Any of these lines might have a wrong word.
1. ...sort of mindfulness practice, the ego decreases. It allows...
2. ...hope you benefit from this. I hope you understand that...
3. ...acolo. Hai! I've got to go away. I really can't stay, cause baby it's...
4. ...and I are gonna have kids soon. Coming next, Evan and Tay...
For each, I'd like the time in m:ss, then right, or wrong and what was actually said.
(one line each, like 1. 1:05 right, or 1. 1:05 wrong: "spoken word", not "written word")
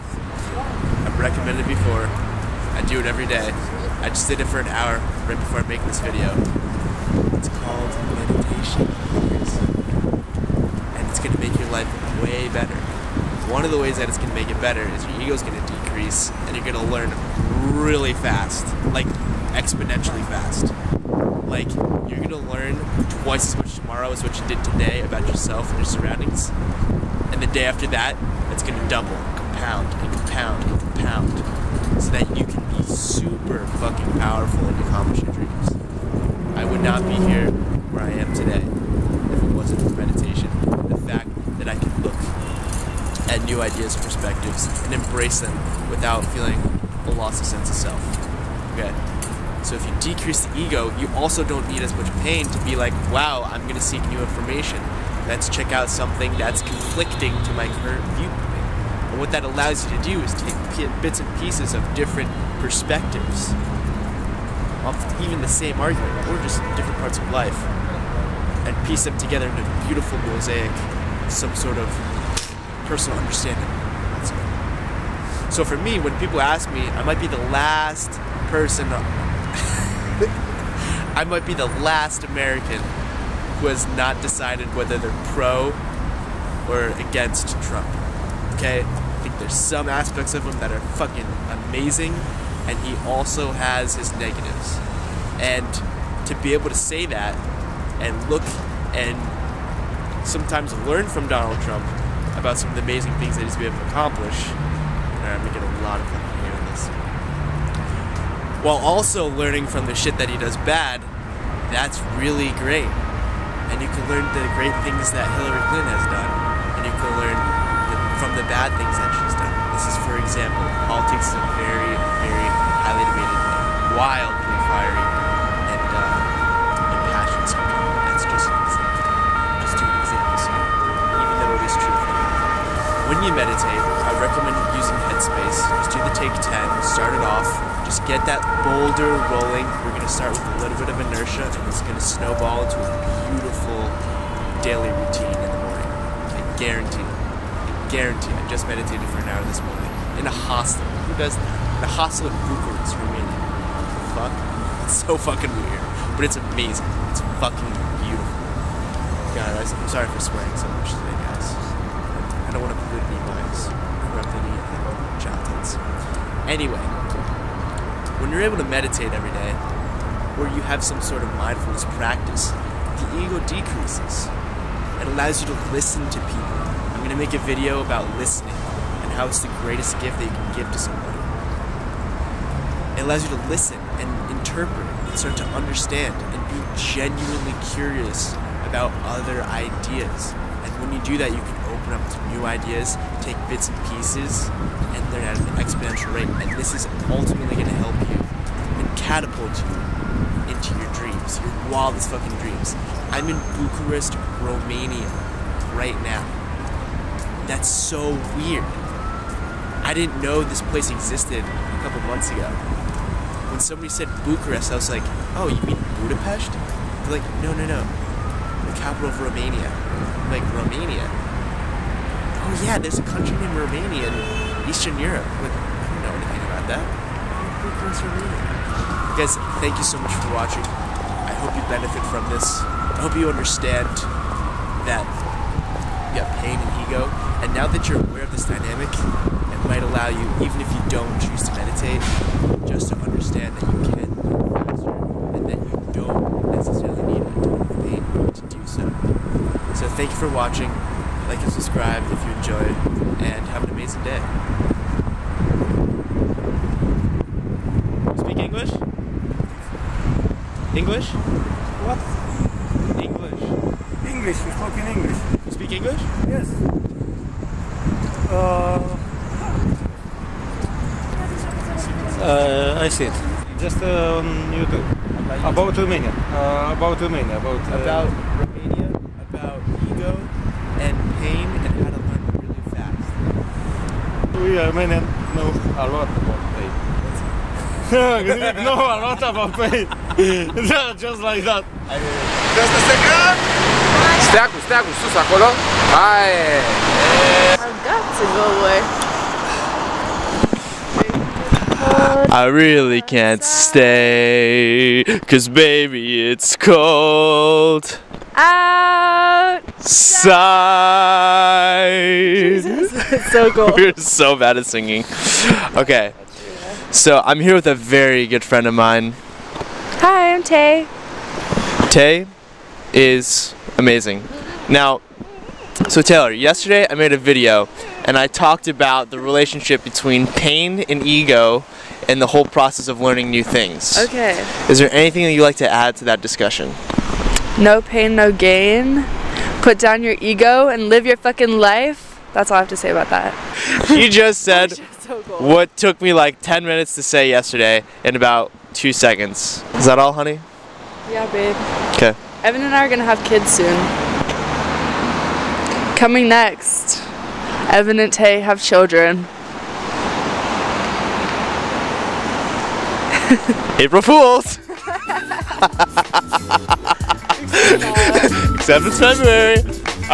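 1. 2:51 right
2. 3:51 right
3. 4:55 right
4. 5:52 right.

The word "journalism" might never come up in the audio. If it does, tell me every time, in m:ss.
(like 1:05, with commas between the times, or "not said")
not said.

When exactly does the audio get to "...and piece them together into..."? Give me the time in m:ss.
1:08.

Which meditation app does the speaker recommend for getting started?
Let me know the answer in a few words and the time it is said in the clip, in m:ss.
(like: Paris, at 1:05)
Take 10, at 2:16.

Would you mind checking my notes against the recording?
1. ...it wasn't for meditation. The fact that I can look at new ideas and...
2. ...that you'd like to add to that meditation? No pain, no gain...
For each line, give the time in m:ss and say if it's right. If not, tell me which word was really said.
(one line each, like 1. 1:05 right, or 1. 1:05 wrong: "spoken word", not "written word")
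1. 0:39 right
2. 5:35 wrong: "discussion", not "meditation".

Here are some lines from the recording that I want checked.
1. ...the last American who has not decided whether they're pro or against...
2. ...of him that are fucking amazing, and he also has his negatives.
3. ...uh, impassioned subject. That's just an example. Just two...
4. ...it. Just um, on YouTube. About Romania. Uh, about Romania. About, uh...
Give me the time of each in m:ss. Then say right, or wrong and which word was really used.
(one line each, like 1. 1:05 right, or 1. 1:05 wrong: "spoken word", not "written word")
1. 1:21 right
2. 1:30 right
3. 2:05 right
4. 4:33 right.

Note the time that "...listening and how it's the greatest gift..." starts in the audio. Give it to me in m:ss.
2:58.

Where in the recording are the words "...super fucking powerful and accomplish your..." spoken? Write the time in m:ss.
0:32.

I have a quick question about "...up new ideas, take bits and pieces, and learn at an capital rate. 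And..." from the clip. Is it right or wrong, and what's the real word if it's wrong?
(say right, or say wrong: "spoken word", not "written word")
wrong: "exponential", not "capital".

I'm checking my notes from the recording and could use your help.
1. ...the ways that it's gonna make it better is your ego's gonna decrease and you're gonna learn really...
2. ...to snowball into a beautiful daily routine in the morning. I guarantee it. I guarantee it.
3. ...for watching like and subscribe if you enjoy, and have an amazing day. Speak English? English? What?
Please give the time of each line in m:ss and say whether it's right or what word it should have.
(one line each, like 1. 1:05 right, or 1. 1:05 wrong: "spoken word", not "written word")
1. 0:13 right
2. 2:21 right
3. 4:10 right.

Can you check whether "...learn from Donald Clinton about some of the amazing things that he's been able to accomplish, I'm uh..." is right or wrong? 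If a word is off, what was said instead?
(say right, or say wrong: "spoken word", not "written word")
wrong: "Trump", not "Clinton".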